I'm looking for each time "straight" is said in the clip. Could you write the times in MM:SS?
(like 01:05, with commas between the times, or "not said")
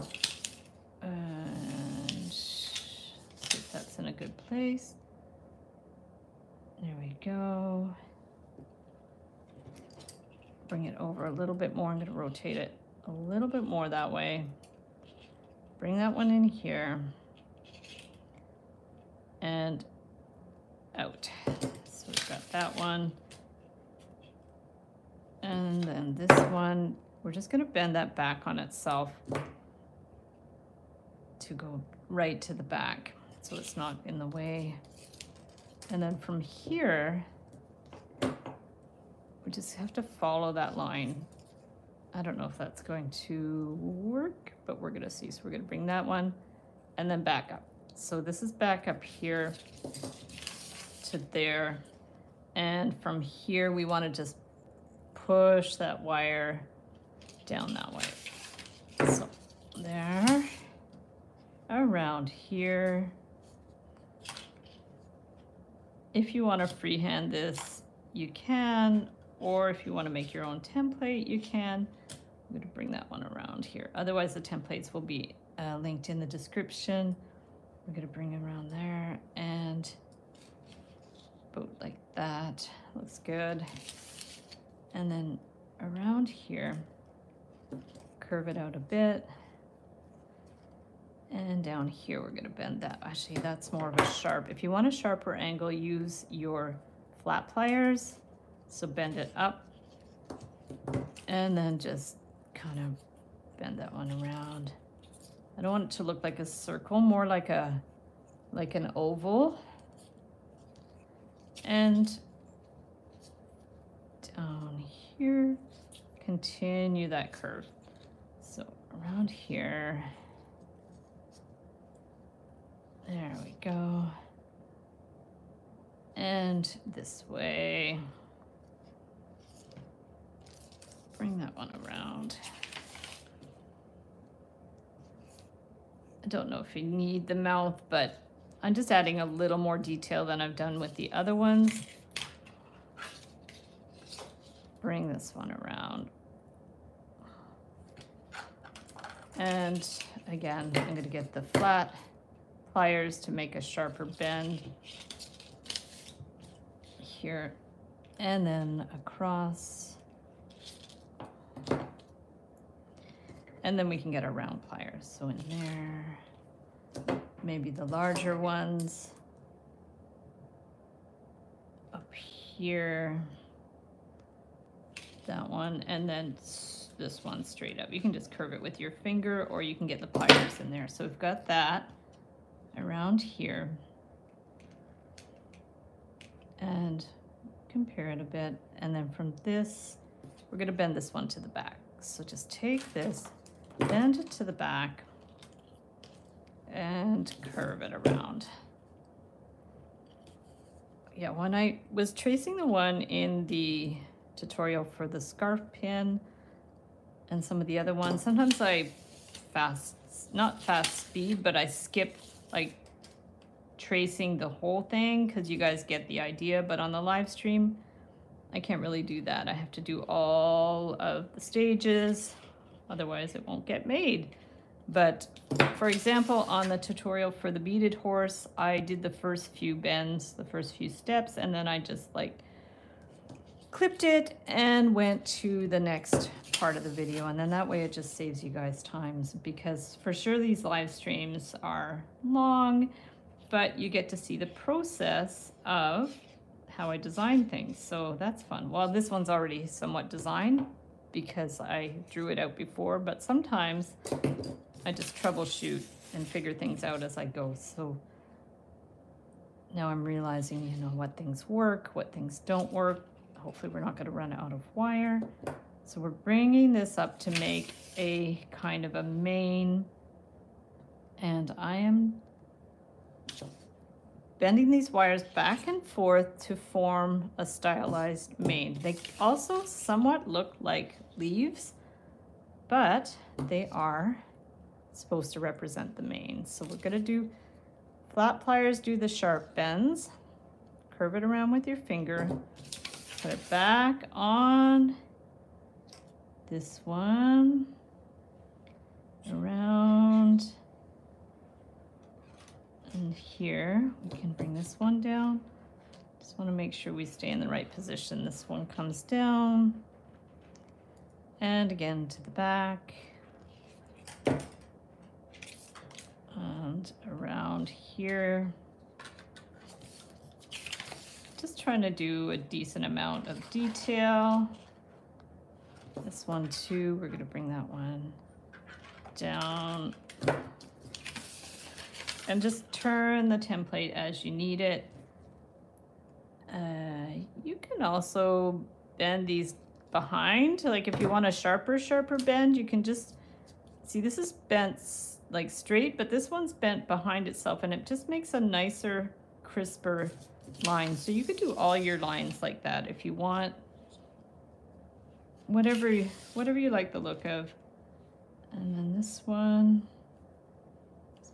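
02:57, 05:45.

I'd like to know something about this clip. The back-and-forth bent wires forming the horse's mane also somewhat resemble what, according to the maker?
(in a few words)
Leaves.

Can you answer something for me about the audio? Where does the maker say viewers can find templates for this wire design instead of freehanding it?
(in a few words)
In the description.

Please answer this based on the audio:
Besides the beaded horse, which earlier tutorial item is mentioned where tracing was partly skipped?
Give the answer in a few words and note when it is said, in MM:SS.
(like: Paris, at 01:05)
Scarf pin, at 03:25.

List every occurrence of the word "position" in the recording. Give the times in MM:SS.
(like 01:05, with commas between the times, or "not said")
05:07.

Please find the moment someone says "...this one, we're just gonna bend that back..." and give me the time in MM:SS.
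00:26.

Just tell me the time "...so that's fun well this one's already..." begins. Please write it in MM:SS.
04:07.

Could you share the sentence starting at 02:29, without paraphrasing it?
And again, I'm gonna get the flat pliers to make a sharper bend here and then across.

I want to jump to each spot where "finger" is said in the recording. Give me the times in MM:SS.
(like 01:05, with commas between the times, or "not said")
02:58, 04:51.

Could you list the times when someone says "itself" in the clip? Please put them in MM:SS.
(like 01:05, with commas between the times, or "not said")
00:28, 05:47.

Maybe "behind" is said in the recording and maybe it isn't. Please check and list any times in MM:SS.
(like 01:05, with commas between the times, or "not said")
05:39, 05:46.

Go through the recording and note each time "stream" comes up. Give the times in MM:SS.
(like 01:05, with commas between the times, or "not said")
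03:37, 04:00.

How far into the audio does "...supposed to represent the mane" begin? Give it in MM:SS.
04:44.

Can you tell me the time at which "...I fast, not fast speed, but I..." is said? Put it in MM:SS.
03:28.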